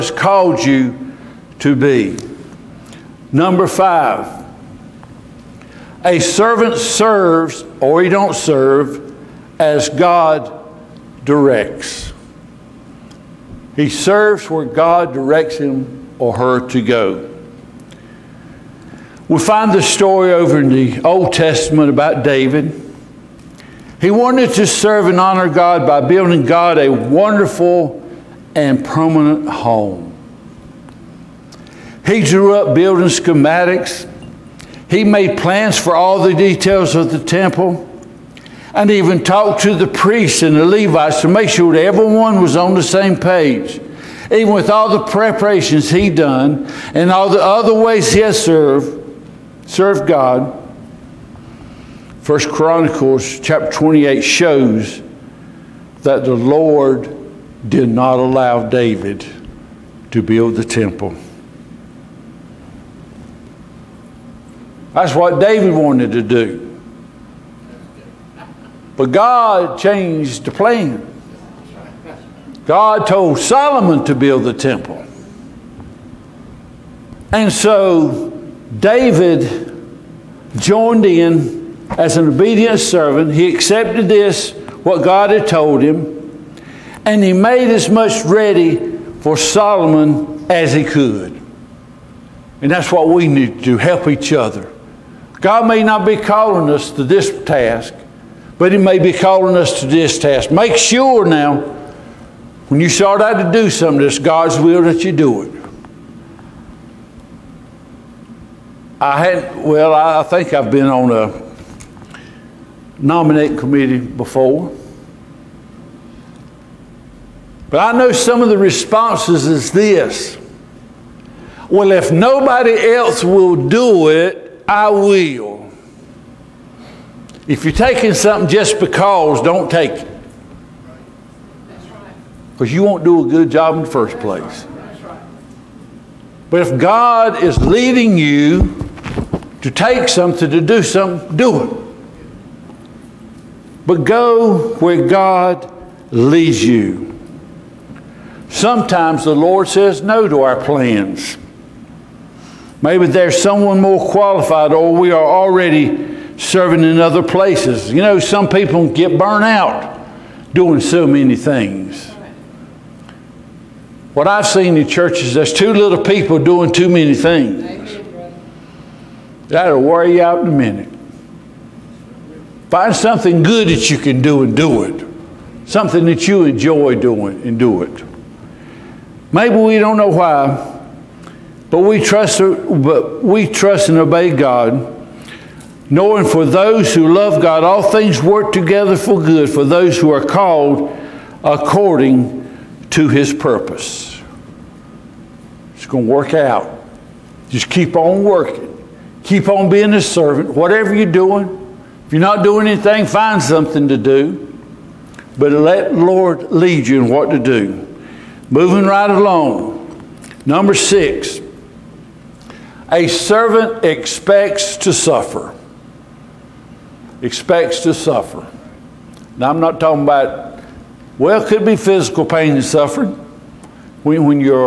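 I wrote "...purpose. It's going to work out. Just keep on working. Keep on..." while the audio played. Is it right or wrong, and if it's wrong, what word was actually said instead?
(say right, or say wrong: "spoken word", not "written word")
right.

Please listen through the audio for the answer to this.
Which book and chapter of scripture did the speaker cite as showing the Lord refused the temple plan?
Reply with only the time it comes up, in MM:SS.
00:52.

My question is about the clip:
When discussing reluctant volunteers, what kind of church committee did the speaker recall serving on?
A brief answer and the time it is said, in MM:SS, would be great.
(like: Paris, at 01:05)
Nominating committee, at 01:52.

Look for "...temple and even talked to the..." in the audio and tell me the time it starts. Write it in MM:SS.
00:37.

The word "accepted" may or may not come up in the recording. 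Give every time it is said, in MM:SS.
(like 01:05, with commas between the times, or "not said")
01:23.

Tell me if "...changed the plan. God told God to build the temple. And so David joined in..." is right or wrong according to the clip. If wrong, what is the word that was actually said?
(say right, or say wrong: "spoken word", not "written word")
wrong: "Solomon", not "God".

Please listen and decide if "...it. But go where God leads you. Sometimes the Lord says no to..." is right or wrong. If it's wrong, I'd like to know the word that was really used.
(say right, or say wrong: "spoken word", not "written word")
right.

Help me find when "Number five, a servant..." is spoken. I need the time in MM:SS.
00:03.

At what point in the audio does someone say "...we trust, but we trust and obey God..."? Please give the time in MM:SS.
03:01.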